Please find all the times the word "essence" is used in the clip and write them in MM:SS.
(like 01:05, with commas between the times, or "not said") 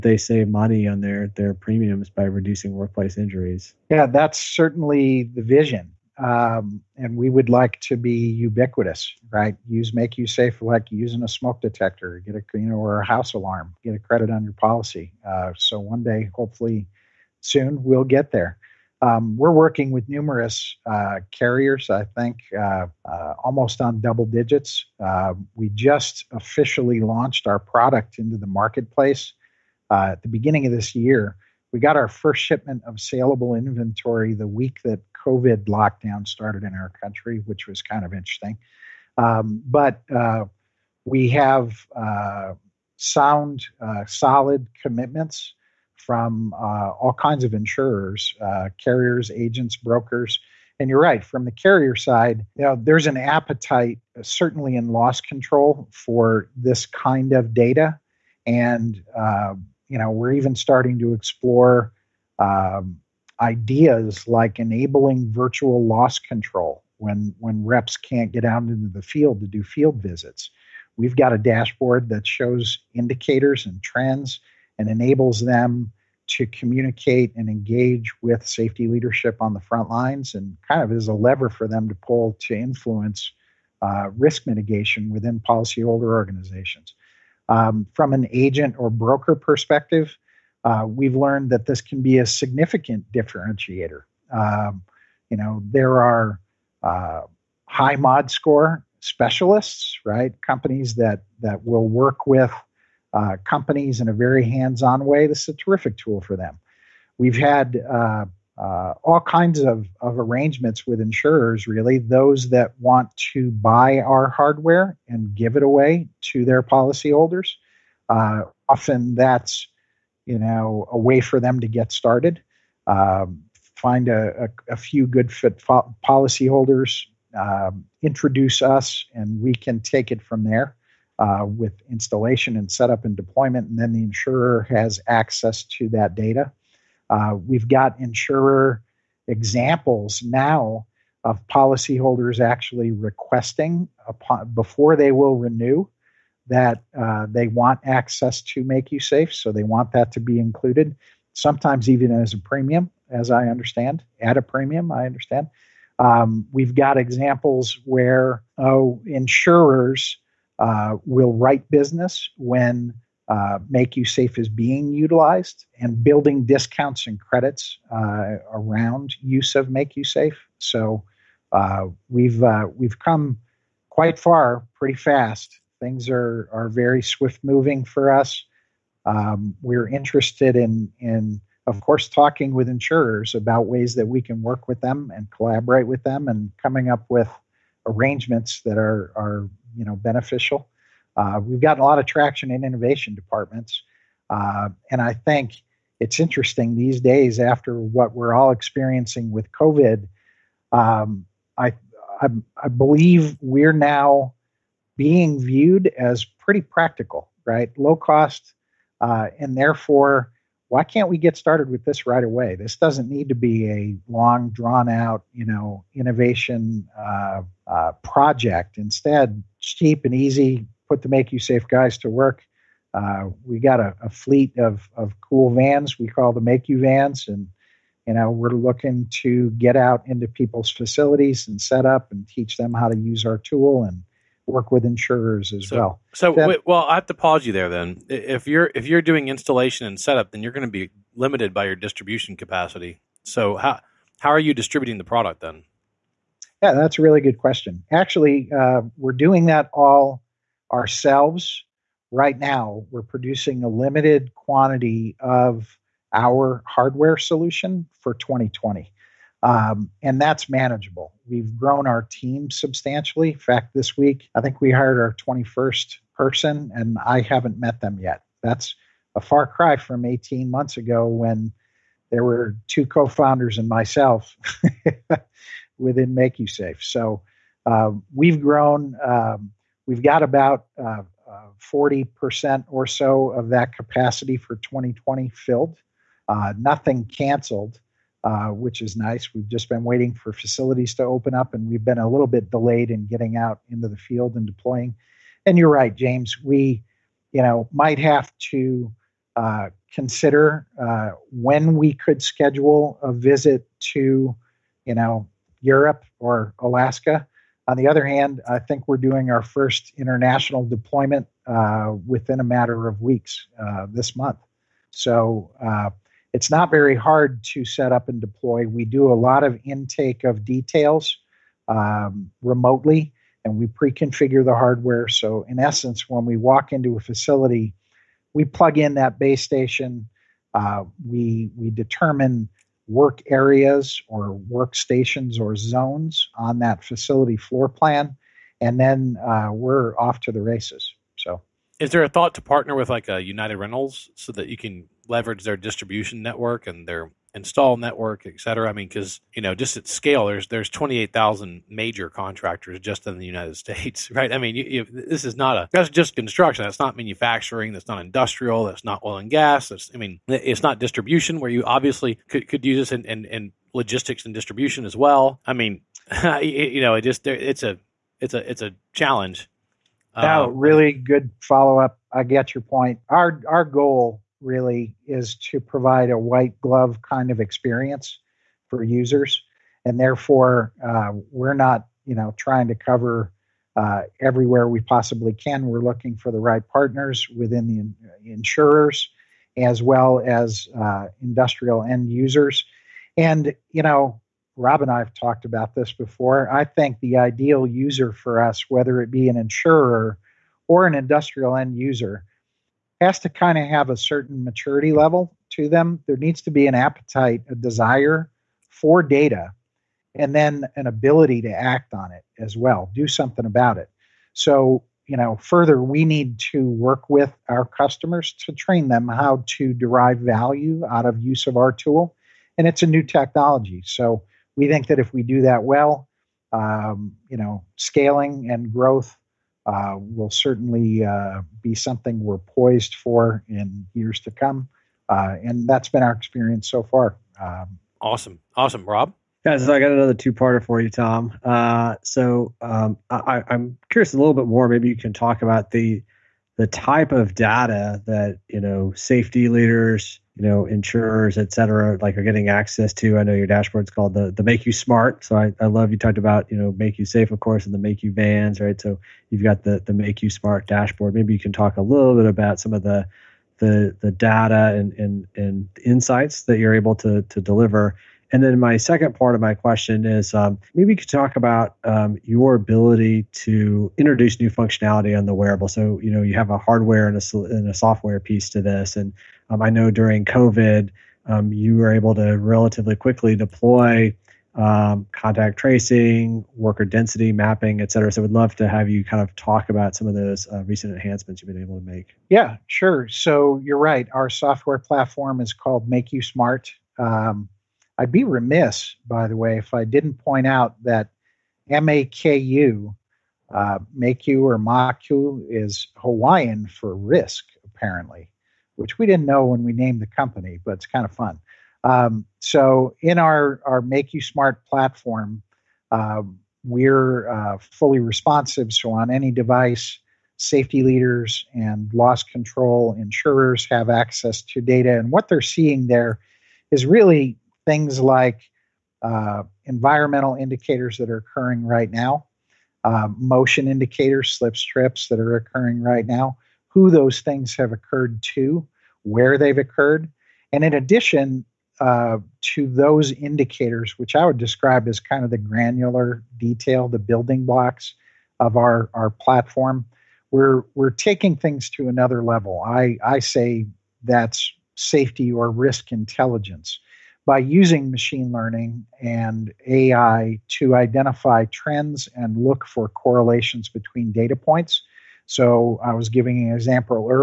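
05:25.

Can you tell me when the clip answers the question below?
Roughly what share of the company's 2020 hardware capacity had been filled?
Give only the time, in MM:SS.
04:41.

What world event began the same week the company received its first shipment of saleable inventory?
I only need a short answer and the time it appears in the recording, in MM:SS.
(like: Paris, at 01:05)
COVID lockdown, at 00:35.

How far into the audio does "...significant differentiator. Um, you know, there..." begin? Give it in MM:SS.
01:32.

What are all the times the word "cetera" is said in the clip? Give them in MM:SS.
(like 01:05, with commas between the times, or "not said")
05:48, 07:31, 08:07.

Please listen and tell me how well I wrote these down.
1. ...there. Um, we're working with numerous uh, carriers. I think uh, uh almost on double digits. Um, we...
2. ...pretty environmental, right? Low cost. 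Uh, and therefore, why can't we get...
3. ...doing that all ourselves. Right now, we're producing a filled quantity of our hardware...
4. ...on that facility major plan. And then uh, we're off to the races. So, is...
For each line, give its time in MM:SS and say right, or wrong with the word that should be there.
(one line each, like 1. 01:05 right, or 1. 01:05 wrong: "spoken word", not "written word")
1. 00:18 right
2. 03:26 wrong: "practical", not "environmental"
3. 04:09 wrong: "limited", not "filled"
4. 05:36 wrong: "floor", not "major".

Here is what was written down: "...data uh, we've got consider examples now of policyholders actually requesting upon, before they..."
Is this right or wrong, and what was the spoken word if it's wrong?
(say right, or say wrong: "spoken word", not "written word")
wrong: "insurer", not "consider".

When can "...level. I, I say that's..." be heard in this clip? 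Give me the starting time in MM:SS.
09:12.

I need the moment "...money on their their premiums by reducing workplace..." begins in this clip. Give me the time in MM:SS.
00:00.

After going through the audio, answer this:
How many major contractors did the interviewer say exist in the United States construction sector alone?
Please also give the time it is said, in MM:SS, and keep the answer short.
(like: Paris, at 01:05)
28,000, at 05:50.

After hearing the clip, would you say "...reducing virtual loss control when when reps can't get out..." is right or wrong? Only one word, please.
wrong.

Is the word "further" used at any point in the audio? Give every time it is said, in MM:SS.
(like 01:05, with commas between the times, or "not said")
06:55.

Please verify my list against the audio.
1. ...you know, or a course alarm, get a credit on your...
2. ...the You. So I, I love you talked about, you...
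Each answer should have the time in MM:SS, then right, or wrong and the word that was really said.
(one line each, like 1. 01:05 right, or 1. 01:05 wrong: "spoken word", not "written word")
1. 00:12 wrong: "house", not "course"
2. 07:34 wrong: "MakUSmart", not "You".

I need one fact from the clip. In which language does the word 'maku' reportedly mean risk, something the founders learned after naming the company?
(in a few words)
Hawaiian.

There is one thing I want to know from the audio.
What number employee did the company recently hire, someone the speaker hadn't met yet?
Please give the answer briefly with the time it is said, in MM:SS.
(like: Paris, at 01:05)
21st, at 04:25.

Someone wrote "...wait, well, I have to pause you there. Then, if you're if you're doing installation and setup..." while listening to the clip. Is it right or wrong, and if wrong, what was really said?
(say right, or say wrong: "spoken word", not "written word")
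right.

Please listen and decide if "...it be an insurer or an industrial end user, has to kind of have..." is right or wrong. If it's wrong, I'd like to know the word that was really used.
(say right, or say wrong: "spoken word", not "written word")
right.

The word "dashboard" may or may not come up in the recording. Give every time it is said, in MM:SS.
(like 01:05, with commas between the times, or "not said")
01:11, 07:33, 07:40.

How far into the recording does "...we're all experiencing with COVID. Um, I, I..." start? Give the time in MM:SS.
03:18.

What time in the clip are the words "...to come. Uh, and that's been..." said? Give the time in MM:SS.
07:14.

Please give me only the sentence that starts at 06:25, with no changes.
We're looking for the right partners within the uh, insurers as well as uh, industrial end users.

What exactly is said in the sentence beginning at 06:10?
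Now, um, really good follow up.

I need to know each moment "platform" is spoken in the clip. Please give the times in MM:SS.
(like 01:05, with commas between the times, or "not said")
08:14, 08:34, 09:09.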